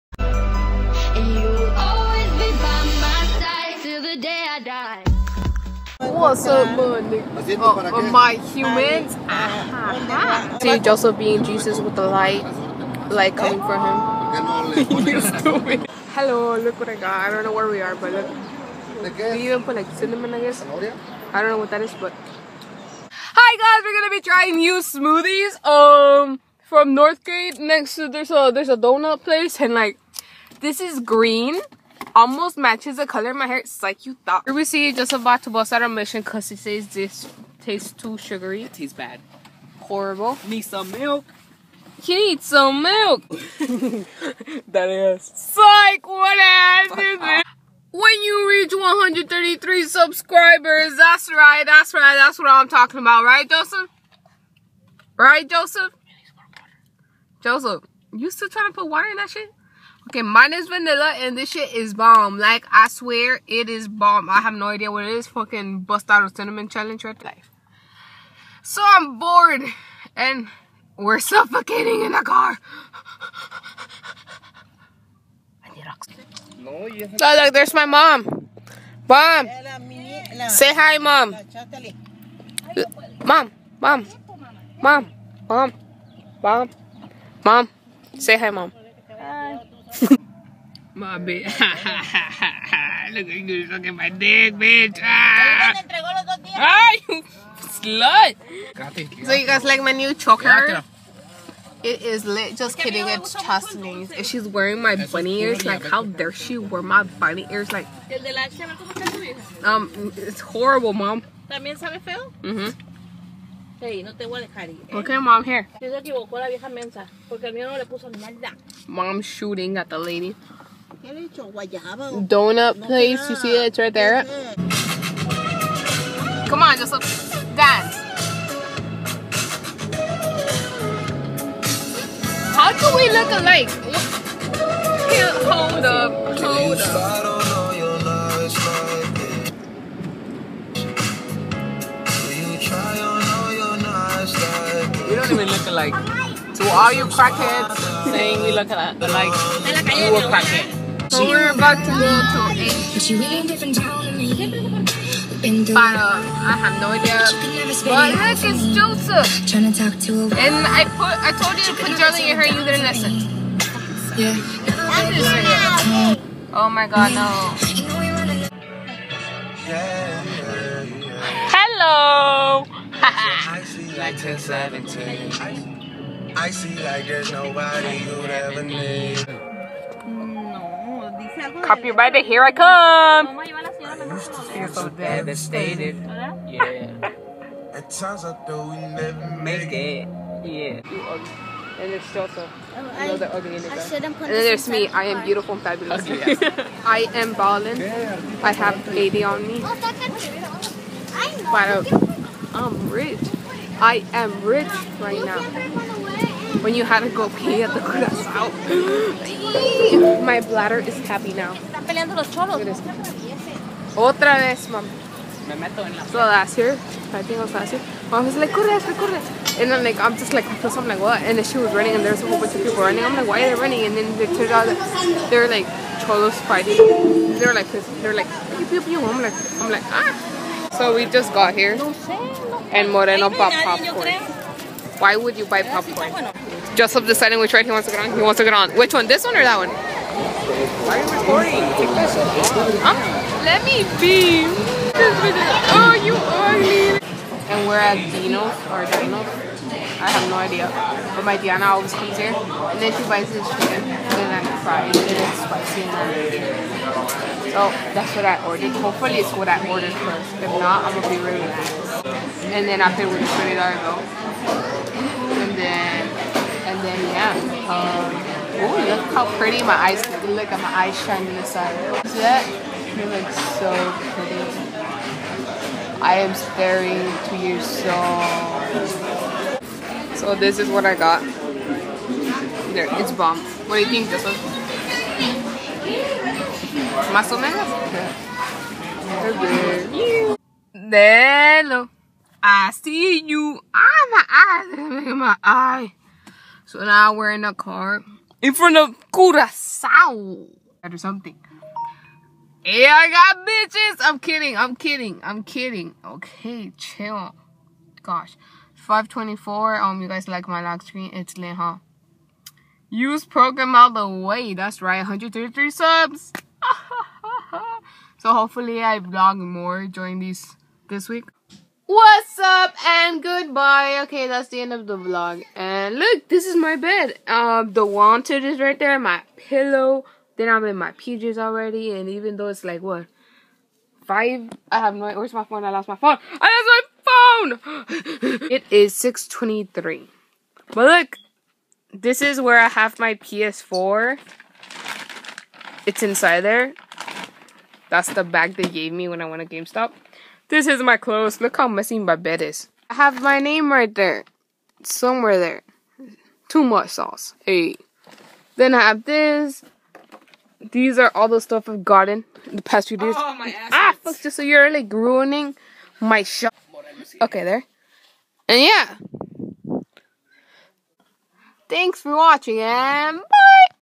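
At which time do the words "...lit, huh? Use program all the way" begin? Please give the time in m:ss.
5:11.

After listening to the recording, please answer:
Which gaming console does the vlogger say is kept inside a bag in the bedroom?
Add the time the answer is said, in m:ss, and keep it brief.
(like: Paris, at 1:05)
PS4, at 5:43.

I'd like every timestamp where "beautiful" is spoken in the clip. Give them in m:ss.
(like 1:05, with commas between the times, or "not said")
3:15.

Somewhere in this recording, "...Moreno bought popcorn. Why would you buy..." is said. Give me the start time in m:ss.
3:52.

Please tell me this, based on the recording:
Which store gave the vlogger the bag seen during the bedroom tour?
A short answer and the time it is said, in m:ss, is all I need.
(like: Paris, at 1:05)
GameStop, at 5:49.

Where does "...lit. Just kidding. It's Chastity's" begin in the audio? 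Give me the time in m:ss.
1:42.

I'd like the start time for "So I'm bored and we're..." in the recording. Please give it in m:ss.
1:08.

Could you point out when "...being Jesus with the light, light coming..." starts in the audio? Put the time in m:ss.
0:11.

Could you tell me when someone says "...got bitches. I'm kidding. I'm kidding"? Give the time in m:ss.
5:03.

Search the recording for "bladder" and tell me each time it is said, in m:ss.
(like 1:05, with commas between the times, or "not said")
3:30.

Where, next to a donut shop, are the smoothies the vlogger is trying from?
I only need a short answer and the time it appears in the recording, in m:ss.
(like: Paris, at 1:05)
Northgate, at 0:26.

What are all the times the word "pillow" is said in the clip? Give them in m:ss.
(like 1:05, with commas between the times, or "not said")
5:29.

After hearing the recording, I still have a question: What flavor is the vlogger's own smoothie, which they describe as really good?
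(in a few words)
Vanilla.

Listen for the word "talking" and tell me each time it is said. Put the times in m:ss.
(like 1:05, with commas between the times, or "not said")
0:52.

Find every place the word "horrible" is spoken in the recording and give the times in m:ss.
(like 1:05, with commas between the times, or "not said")
0:39, 1:50.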